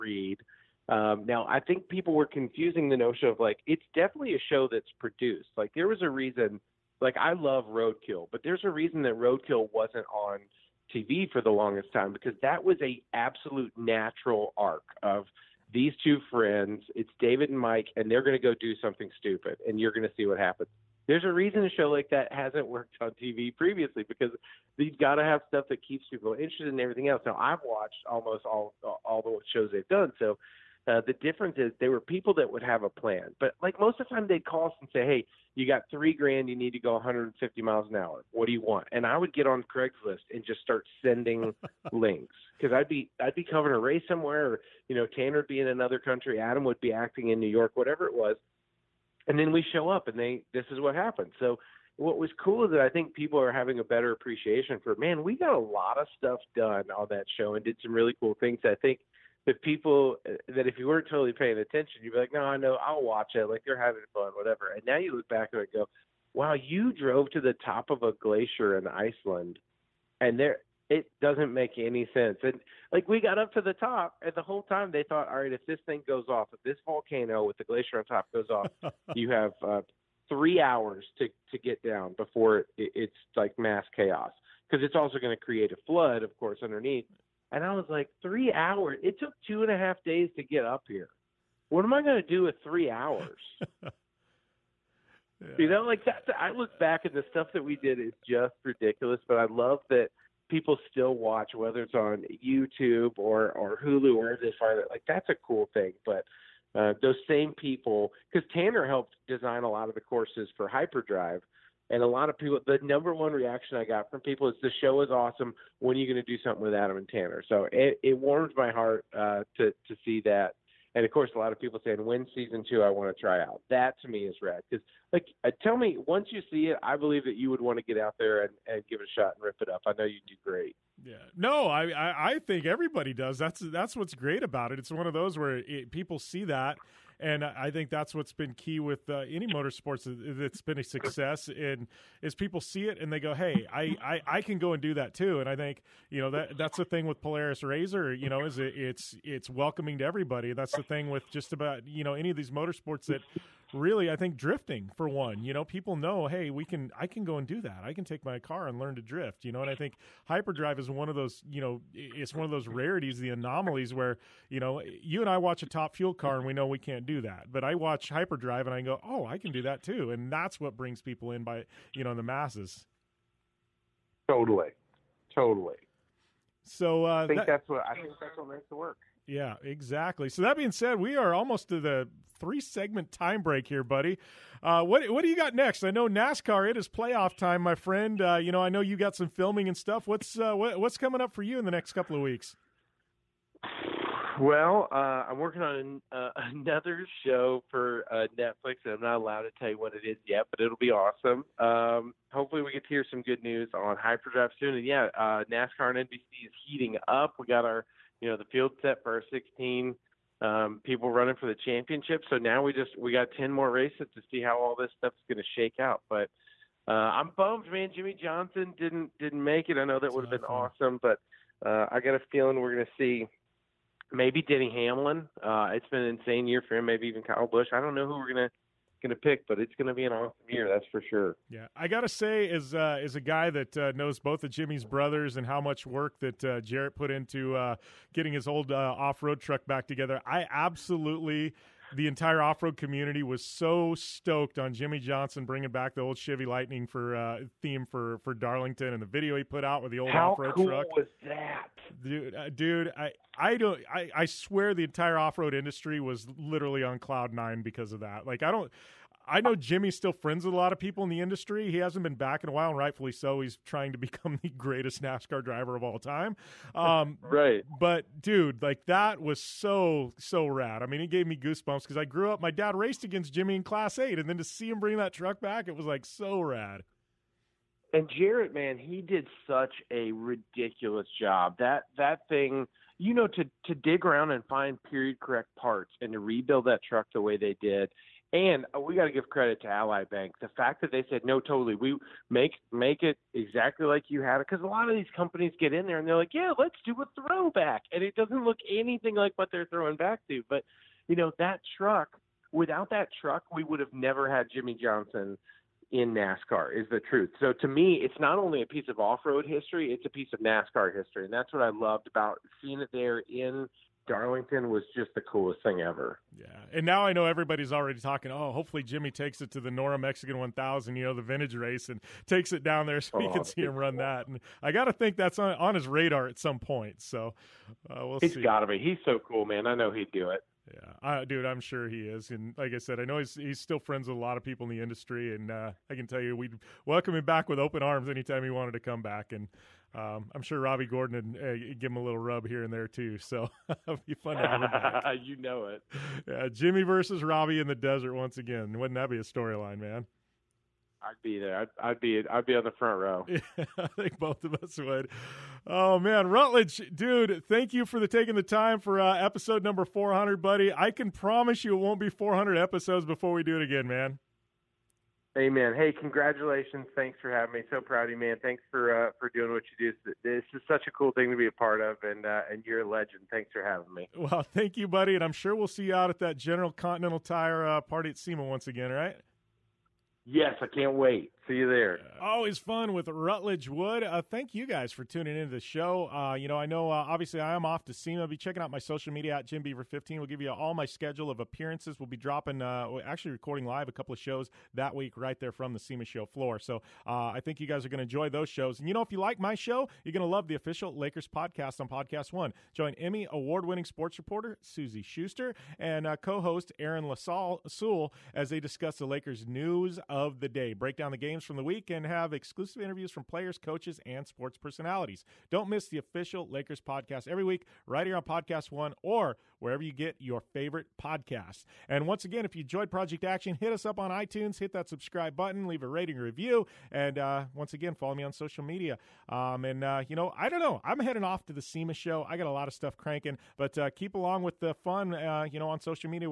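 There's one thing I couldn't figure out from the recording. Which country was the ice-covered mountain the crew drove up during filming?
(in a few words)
Iceland.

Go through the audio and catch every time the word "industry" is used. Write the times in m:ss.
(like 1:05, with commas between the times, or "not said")
4:15, 4:21, 5:34.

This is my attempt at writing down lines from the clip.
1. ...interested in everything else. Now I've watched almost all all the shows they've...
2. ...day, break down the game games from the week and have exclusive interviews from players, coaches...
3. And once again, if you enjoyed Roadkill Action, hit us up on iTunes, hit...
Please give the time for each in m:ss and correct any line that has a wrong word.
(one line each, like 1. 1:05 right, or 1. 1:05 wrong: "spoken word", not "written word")
1. 0:26 right
2. 6:50 right
3. 7:01 wrong: "Project", not "Roadkill".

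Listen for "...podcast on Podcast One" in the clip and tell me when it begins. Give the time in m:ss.
6:41.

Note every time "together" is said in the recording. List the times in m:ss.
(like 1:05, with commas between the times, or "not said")
3:59.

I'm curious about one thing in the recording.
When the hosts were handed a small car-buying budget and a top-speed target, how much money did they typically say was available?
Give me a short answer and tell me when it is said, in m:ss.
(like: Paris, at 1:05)
3 grand, at 0:35.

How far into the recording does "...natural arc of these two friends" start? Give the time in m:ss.
0:13.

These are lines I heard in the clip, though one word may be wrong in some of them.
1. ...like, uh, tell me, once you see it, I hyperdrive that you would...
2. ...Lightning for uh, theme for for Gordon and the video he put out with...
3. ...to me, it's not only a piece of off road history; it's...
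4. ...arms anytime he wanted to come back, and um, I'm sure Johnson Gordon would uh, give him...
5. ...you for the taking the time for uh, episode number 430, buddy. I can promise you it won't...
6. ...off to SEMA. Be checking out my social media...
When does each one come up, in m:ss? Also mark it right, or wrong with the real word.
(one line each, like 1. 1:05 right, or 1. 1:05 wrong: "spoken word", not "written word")
1. 2:05 wrong: "believe", not "hyperdrive"
2. 4:06 wrong: "Darlington", not "Gordon"
3. 5:07 right
4. 5:37 wrong: "Robby", not "Johnson"
5. 5:57 wrong: "400", not "430"
6. 6:27 right.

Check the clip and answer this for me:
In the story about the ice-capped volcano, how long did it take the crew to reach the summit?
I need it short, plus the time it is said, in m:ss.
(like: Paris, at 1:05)
2 and a half days, at 1:29.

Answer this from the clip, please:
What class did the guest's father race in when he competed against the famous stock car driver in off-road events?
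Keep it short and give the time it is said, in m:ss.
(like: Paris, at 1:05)
Class Eight, at 4:33.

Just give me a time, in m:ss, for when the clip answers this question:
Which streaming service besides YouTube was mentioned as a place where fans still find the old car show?
1:43.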